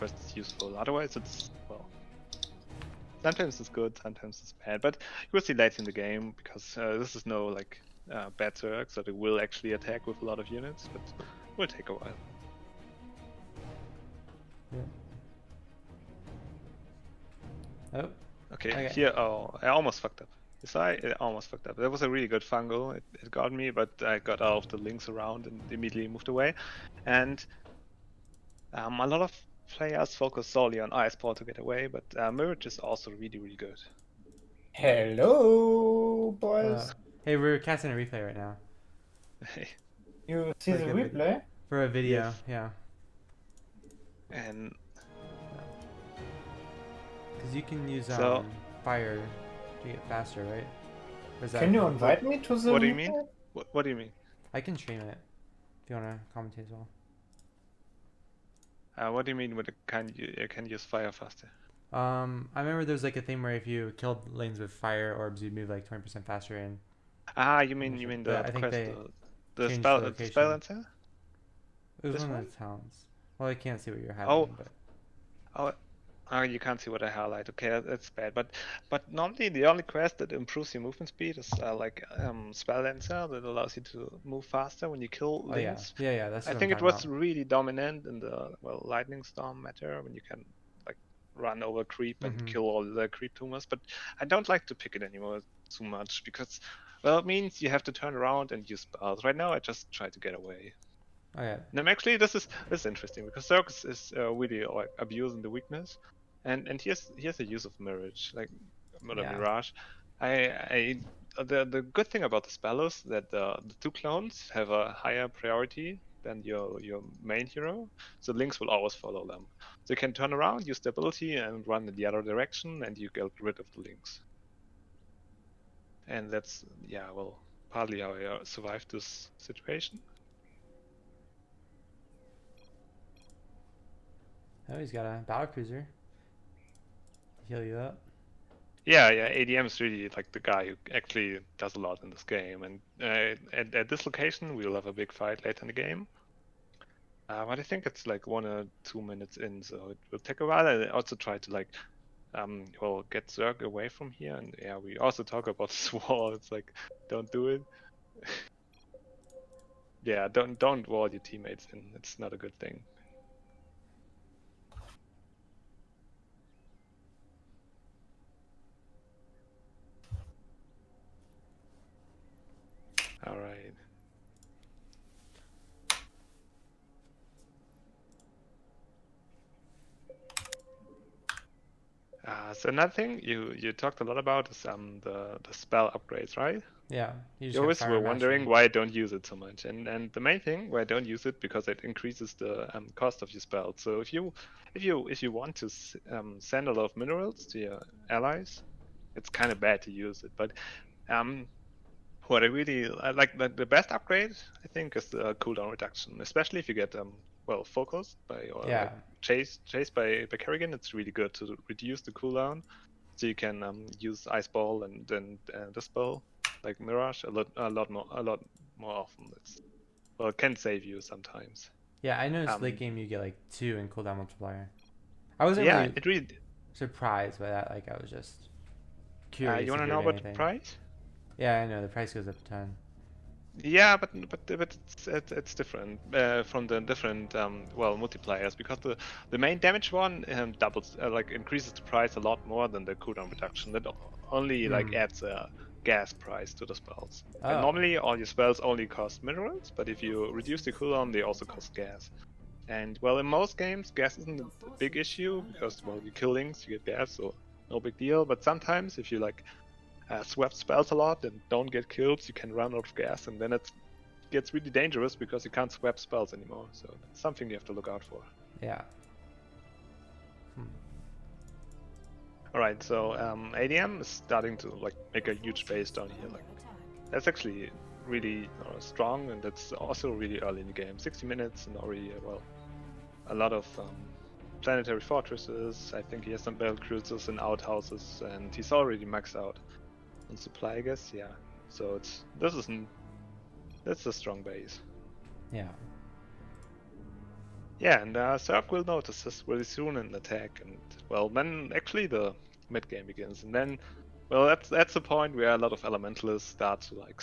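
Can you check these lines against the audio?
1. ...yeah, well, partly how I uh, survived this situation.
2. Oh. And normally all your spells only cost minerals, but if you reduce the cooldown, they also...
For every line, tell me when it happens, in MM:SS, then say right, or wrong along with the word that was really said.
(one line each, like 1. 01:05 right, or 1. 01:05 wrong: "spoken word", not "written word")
1. 02:06 right
2. 04:07 right.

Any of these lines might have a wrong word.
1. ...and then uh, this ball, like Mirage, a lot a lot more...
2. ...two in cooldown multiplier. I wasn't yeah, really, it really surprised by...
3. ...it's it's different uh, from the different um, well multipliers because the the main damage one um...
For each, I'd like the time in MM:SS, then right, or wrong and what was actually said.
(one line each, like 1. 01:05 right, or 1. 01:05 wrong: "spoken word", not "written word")
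1. 03:34 right
2. 03:43 right
3. 03:55 right.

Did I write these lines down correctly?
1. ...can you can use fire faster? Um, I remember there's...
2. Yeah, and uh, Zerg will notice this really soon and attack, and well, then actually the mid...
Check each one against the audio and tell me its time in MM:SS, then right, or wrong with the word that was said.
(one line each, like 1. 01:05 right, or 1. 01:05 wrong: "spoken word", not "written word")
1. 00:59 right
2. 04:57 right.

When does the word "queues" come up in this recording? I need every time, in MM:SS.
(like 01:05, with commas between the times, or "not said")
not said.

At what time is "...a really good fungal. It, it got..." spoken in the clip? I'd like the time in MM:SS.
00:22.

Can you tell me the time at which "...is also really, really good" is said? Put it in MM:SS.
00:32.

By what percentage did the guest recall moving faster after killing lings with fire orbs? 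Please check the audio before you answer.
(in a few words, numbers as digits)
20%.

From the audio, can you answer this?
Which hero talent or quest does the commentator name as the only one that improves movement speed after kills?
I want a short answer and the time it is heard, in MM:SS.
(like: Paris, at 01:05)
Spell Lancer, at 01:22.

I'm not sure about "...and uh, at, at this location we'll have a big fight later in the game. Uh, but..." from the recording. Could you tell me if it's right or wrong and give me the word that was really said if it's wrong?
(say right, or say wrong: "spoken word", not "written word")
right.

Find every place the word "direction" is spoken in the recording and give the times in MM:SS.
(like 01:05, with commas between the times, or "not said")
02:02.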